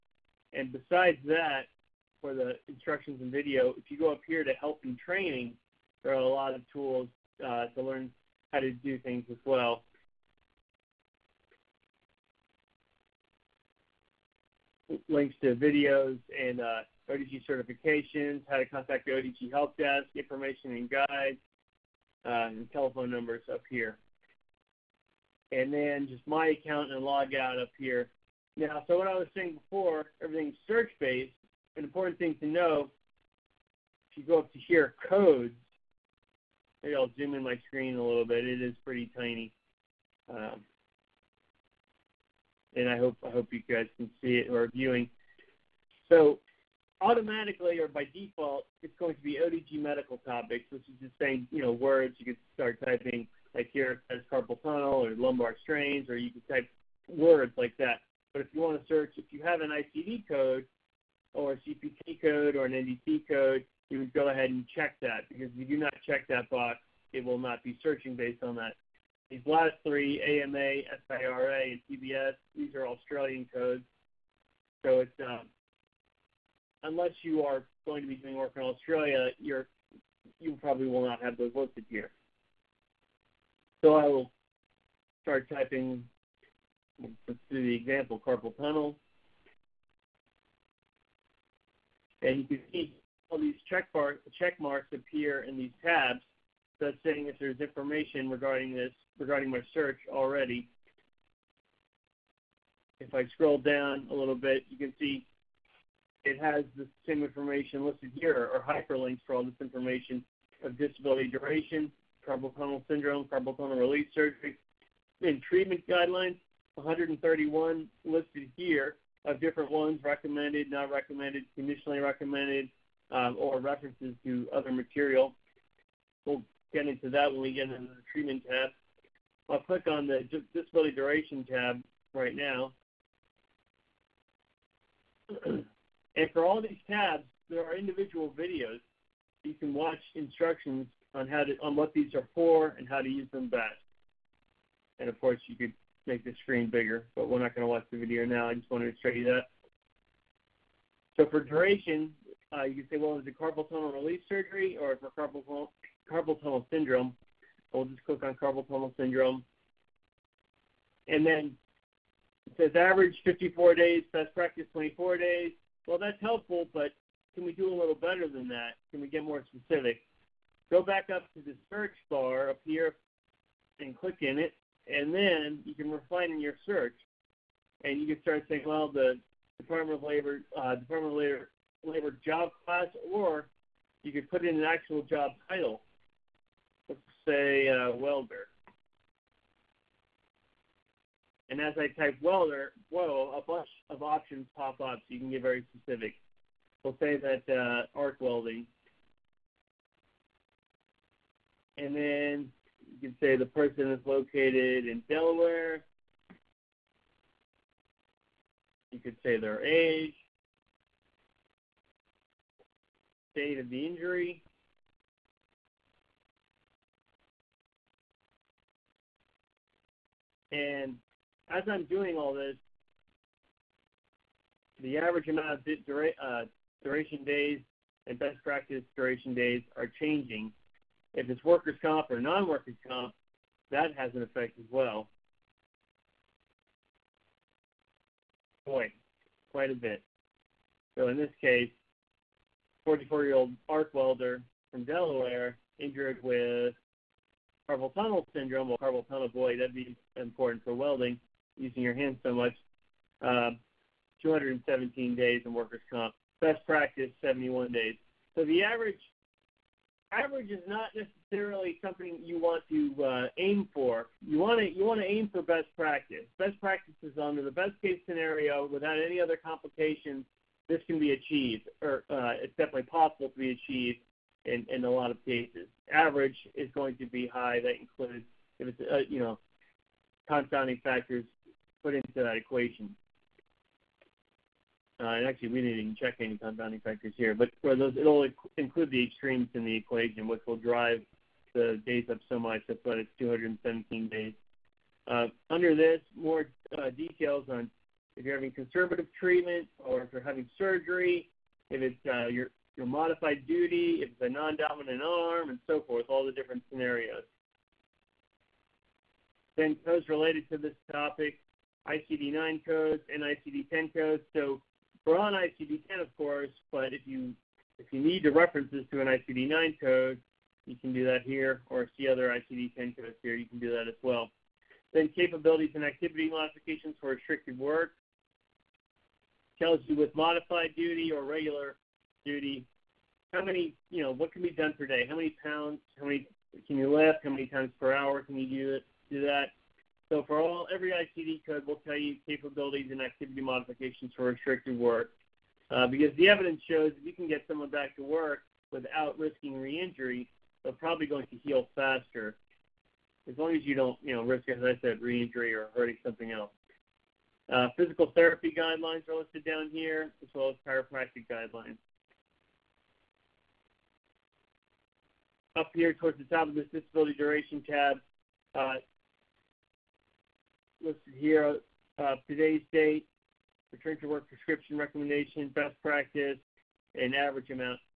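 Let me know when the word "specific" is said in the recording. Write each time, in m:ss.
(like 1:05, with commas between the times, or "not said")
2:49, 3:15.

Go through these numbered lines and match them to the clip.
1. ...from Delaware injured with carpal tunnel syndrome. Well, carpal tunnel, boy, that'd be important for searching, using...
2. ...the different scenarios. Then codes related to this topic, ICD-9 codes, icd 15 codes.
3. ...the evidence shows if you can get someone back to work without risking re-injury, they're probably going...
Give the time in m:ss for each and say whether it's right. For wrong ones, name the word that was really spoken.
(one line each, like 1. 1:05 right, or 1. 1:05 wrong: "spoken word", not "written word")
1. 4:04 wrong: "welding", not "searching"
2. 5:06 wrong: "10", not "15"
3. 5:46 right.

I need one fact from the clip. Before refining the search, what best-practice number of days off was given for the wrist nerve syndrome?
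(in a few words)
24 days.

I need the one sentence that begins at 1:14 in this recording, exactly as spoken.
So it's um, unless you are going to be doing work in Australia, you're you probably will not have those listed here.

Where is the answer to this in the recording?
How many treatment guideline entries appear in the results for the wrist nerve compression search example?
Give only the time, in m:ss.
1:56.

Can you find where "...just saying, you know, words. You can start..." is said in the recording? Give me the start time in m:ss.
0:51.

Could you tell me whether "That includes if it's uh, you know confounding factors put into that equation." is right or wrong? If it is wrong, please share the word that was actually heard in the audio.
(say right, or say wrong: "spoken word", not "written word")
right.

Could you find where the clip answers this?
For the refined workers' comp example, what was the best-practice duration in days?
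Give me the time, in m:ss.
4:17.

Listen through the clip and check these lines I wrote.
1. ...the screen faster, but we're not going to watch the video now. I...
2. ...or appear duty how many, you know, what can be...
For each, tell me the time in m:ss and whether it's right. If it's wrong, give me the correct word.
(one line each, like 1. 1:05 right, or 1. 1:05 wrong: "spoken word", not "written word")
1. 2:26 wrong: "bigger", not "faster"
2. 5:31 wrong: "regular", not "appear".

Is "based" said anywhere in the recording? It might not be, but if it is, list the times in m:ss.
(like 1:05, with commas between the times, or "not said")
0:30, 1:08.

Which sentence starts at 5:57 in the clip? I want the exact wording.
Uh, physical therapy guidelines are listed down here, as well as chiropractic guidelines.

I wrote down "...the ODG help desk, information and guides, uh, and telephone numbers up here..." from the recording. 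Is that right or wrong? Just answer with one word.
right.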